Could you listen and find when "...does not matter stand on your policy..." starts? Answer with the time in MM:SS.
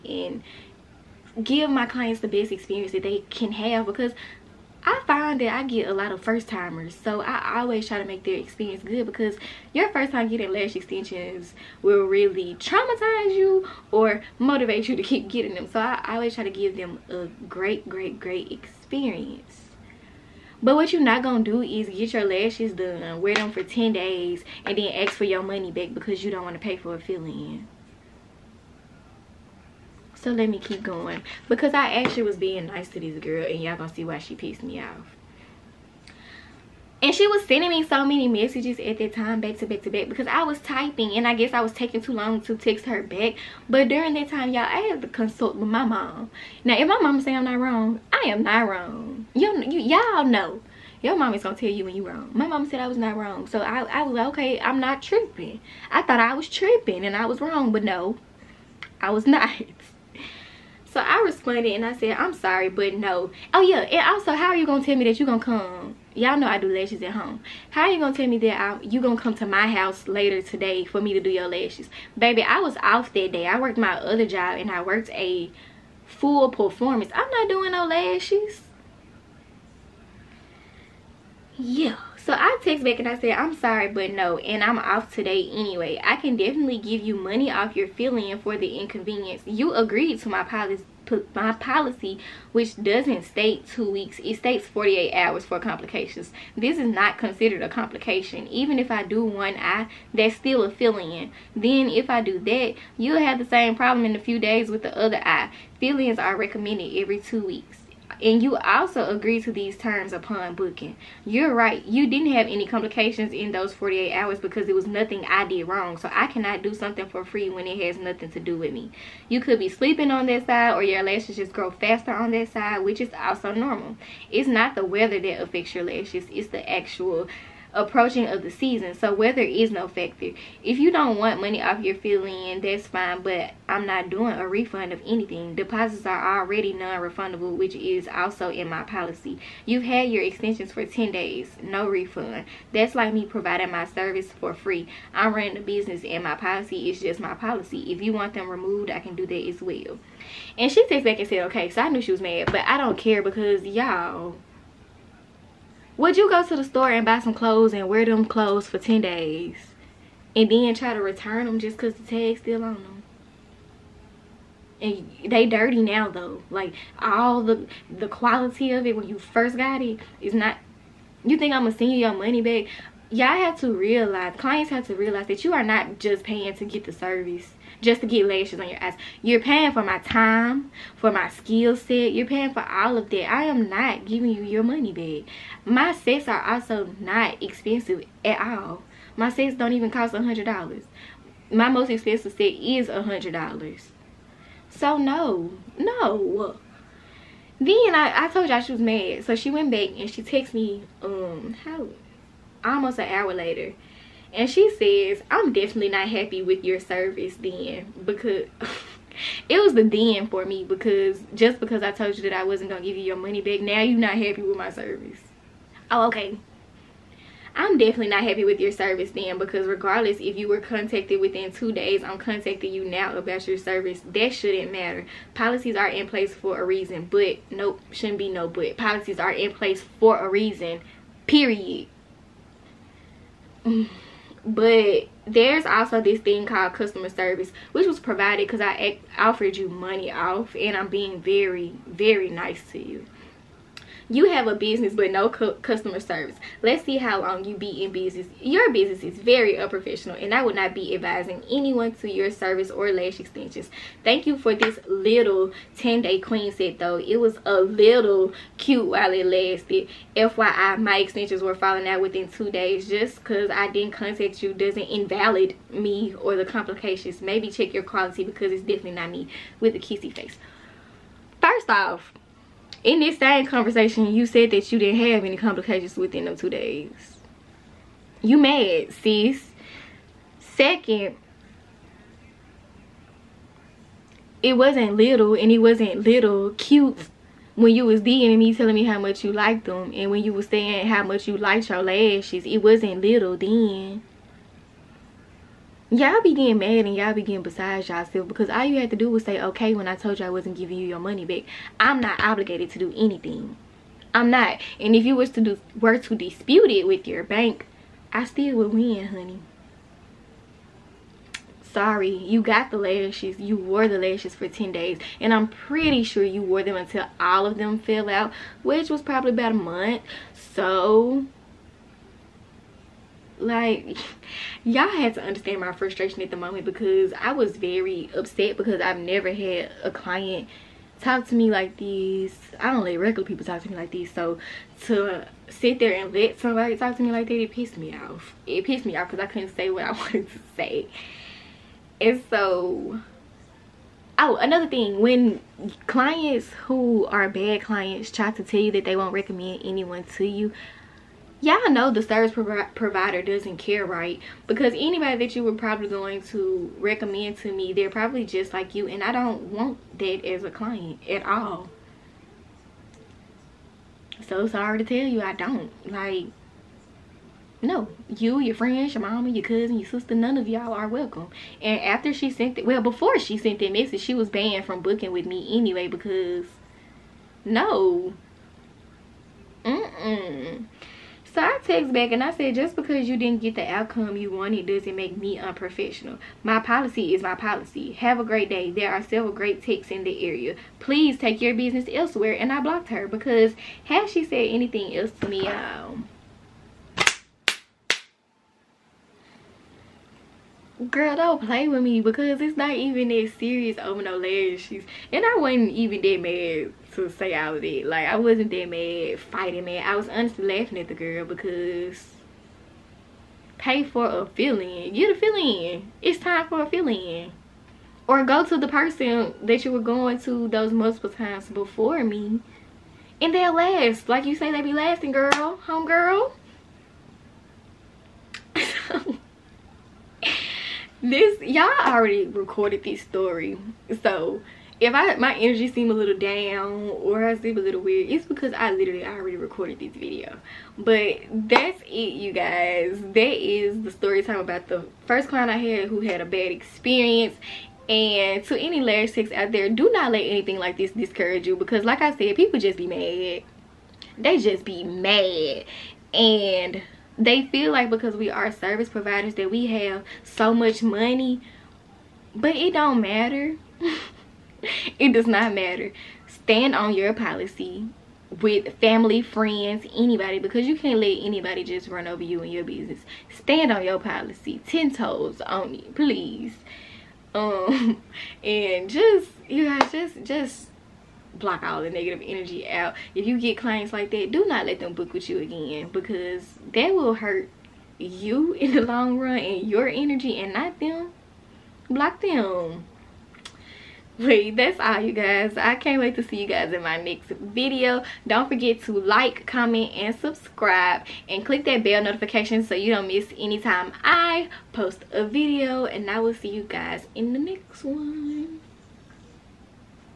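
07:45.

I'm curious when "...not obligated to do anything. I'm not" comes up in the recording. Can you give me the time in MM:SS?
05:02.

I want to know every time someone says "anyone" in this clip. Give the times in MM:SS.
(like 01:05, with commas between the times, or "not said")
04:11, 05:49.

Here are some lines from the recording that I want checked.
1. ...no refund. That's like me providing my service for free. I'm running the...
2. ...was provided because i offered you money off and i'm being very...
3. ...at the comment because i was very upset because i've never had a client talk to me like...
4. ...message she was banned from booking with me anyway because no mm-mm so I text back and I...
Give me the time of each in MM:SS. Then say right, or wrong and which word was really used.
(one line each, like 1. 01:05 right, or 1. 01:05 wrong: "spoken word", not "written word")
1. 02:21 right
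2. 03:57 right
3. 05:26 wrong: "moment", not "comment"
4. 06:13 right.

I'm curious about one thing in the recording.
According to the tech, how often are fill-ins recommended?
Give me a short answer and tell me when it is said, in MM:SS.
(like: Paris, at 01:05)
Every two weeks, at 01:46.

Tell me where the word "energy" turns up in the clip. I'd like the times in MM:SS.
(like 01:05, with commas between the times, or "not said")
07:15, 08:02, 08:09.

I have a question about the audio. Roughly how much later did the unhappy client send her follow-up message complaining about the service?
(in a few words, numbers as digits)
Almost an hour.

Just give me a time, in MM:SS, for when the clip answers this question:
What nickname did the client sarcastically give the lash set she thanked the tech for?
04:15.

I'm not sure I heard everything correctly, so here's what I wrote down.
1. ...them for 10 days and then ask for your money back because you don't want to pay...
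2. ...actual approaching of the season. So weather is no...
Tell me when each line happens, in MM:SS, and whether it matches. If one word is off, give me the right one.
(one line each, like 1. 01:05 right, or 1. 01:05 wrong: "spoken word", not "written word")
1. 00:23 right
2. 02:06 right.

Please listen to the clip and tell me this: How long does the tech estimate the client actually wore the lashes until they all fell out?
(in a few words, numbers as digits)
About a month.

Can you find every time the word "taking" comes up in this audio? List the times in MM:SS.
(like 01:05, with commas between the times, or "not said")
00:41.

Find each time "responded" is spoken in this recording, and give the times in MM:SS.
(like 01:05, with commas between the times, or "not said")
01:01.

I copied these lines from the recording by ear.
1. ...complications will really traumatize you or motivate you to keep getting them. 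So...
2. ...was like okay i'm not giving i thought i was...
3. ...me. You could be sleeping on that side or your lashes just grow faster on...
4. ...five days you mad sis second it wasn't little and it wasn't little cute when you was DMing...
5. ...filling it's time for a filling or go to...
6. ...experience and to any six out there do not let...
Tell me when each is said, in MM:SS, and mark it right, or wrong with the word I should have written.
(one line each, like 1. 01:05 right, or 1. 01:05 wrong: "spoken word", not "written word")
1. 00:10 wrong: "extensions", not "complications"
2. 00:54 wrong: "tripping", not "giving"
3. 01:58 right
4. 04:36 wrong: "two", not "five"
5. 06:55 right
6. 07:26 right.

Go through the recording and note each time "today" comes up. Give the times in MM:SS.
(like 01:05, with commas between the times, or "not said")
01:10, 01:25.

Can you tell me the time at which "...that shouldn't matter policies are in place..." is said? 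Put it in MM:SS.
03:44.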